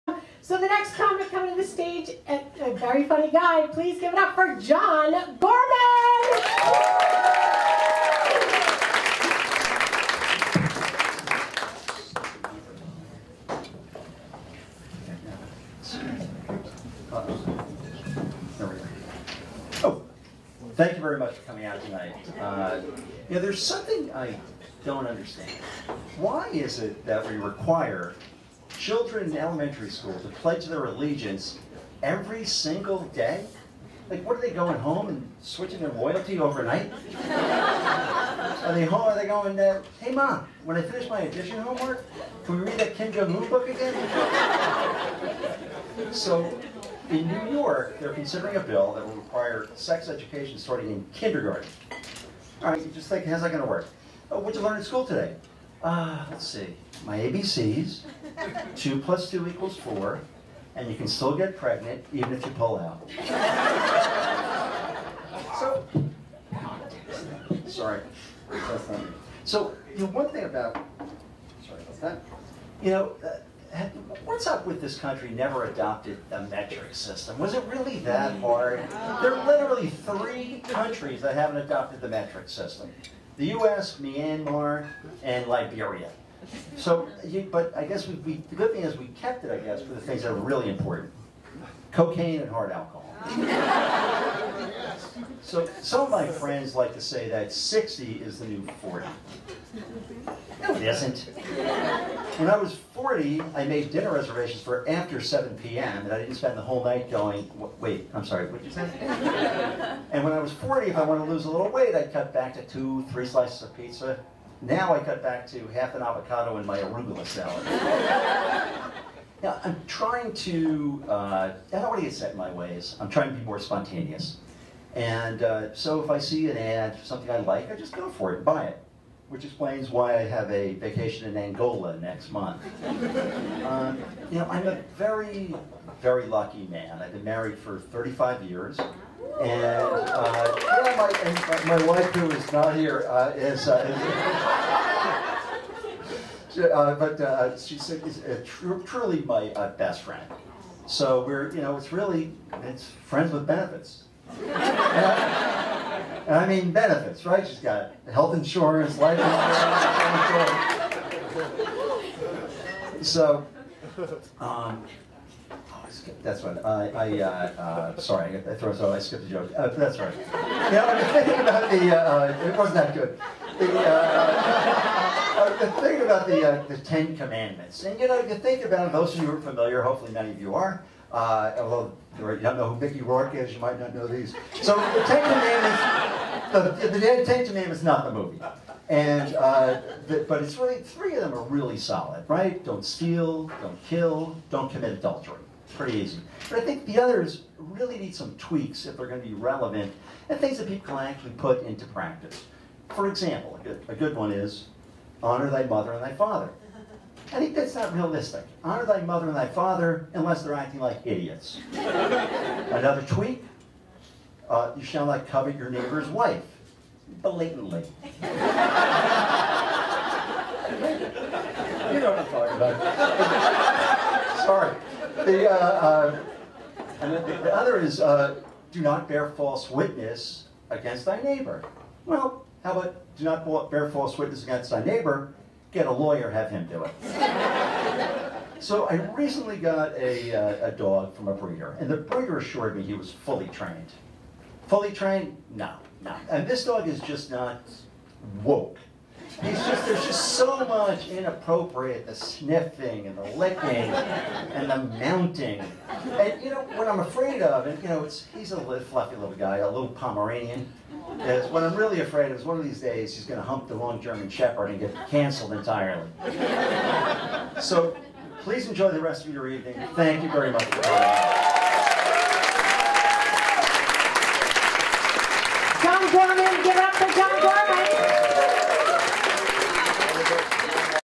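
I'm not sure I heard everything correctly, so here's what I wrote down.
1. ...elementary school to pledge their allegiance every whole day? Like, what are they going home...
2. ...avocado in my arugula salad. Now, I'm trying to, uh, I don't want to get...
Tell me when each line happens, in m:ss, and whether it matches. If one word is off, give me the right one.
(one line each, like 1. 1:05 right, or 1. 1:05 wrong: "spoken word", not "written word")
1. 0:29 wrong: "single", not "whole"
2. 1:56 right.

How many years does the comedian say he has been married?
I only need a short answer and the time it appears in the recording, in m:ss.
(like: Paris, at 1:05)
35, at 2:17.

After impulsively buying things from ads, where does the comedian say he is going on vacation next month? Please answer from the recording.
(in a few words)
Angola.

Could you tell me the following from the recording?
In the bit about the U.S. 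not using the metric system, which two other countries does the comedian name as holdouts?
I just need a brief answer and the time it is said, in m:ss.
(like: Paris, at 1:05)
Myanmar and Liberia, at 1:23.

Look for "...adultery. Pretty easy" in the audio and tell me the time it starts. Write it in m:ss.
3:14.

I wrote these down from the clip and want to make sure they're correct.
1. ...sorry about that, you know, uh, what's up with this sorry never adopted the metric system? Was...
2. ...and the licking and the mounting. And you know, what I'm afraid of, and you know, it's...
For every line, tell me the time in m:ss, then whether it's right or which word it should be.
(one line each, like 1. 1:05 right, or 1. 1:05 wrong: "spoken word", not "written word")
1. 1:11 wrong: "country", not "sorry"
2. 4:13 right.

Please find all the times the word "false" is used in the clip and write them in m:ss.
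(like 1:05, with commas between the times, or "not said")
3:49, 3:53.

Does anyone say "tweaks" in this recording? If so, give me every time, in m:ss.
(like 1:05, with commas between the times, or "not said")
3:18, 3:33.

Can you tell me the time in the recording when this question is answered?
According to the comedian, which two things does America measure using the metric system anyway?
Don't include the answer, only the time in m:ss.
1:31.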